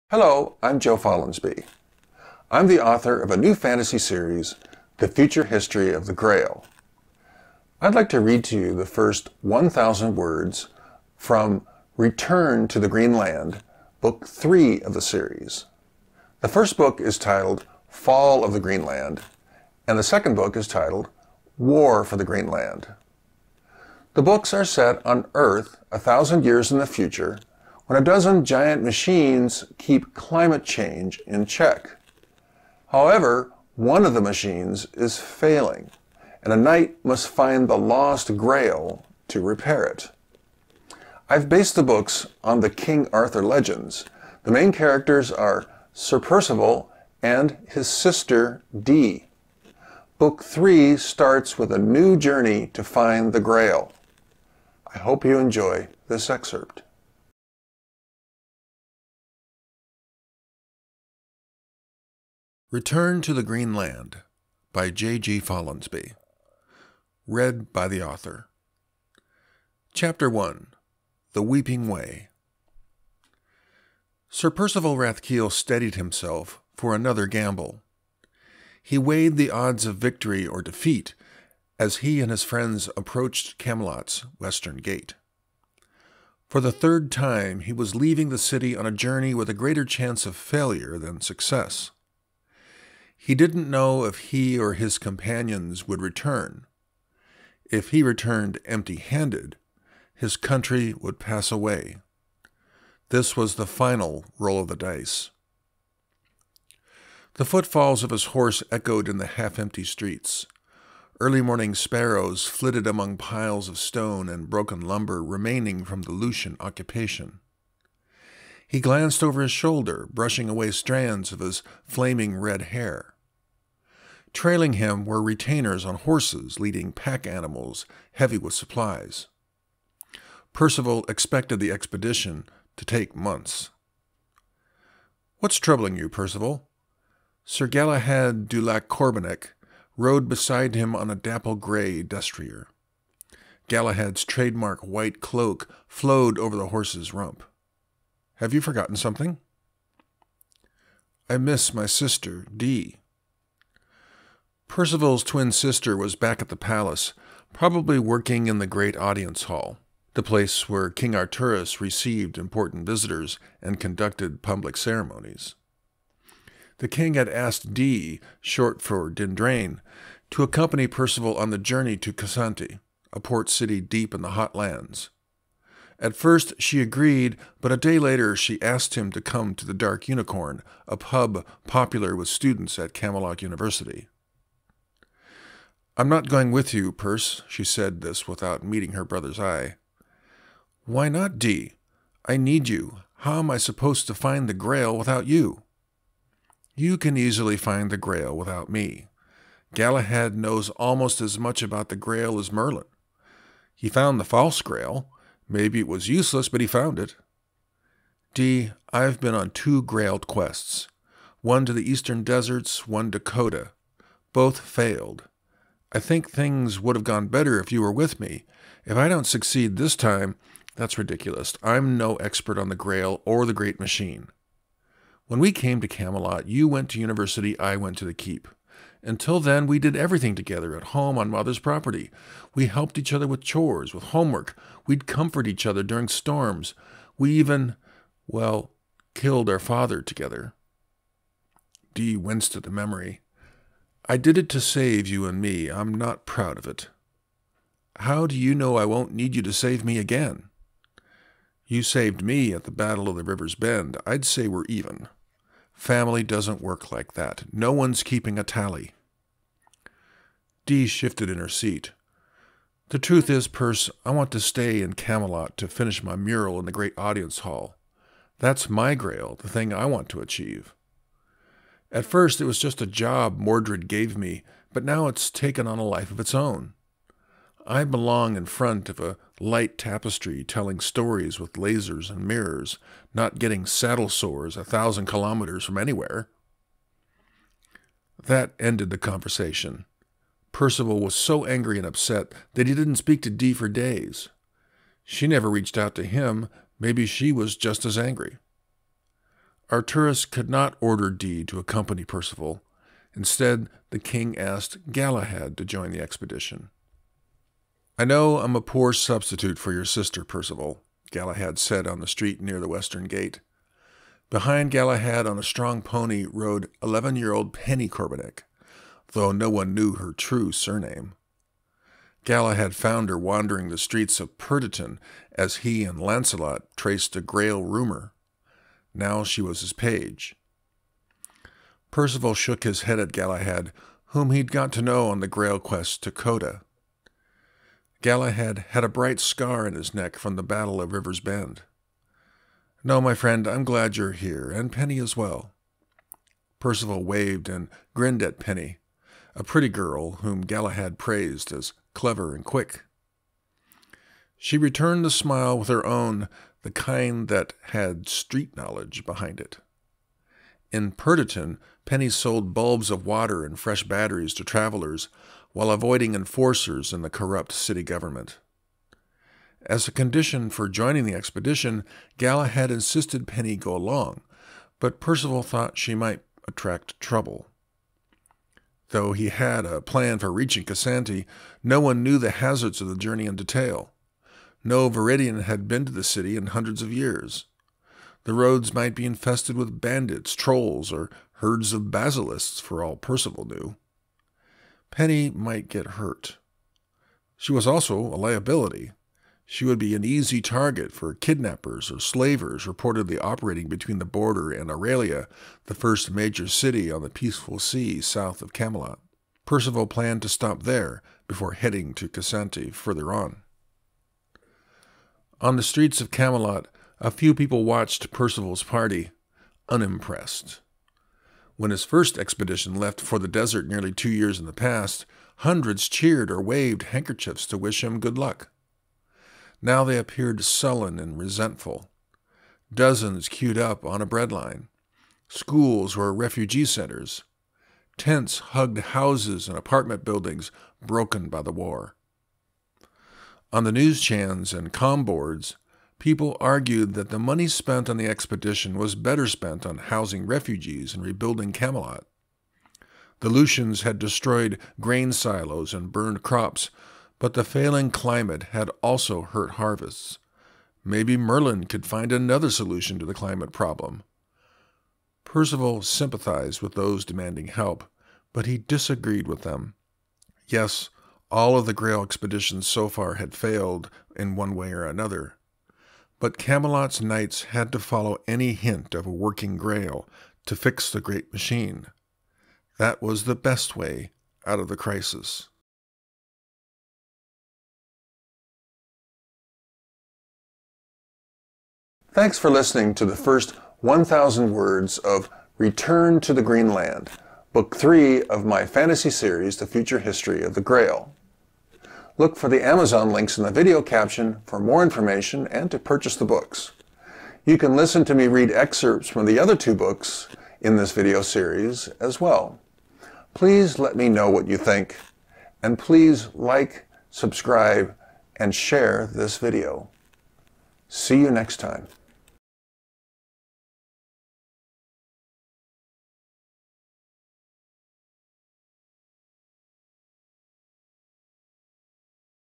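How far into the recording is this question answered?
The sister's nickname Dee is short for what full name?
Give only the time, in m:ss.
2:49.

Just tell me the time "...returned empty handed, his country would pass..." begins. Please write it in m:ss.
1:38.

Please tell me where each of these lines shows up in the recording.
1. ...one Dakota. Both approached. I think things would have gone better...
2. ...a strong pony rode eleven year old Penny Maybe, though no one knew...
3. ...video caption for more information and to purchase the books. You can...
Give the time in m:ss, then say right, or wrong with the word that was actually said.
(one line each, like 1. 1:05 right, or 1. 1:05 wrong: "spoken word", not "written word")
1. 3:32 wrong: "failed", not "approached"
2. 5:15 wrong: "Corbinick", not "Maybe"
3. 8:23 right.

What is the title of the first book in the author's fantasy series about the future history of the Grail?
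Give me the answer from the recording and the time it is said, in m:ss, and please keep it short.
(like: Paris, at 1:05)
Fall of the Green Land, at 0:17.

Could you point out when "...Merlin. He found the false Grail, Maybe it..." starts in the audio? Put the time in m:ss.
3:22.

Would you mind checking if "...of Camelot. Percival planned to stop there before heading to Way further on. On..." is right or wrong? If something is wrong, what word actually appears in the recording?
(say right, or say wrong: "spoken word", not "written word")
wrong: "Cassanti", not "Way".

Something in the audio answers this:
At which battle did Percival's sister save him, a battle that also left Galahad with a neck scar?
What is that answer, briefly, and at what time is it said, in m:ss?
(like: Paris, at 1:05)
Battle of the River's Bend, at 4:12.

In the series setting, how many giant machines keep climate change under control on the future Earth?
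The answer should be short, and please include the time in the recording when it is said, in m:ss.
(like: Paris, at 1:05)
12, at 0:28.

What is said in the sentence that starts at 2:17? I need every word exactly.
Sir Galahad du Lac Corbenac rode beside him on a dapple gray destrier.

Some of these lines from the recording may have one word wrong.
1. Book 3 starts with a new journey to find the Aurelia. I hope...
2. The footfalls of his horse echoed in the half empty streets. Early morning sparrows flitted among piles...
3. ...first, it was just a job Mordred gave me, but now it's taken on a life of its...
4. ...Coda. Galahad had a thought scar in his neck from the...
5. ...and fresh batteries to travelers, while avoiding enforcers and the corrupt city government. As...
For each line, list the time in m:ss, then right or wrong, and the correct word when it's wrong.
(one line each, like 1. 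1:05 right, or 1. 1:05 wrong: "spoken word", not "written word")
1. 0:50 wrong: "Grail", not "Aurelia"
2. 1:47 right
3. 4:32 right
4. 5:36 wrong: "bright", not "thought"
5. 6:03 right.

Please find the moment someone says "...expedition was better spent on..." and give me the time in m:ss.
7:28.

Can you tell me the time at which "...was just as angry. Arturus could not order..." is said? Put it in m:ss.
4:57.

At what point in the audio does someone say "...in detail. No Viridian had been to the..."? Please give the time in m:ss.
6:23.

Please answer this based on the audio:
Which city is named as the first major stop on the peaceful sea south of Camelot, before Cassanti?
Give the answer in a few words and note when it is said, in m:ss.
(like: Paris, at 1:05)
Aurelia, at 6:44.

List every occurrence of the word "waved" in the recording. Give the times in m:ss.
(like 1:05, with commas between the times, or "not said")
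5:47, 7:06.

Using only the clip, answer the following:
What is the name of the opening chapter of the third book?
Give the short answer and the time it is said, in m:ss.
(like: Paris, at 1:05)
The Weeping Way, at 1:11.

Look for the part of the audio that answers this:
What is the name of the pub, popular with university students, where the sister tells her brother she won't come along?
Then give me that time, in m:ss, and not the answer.
2:59.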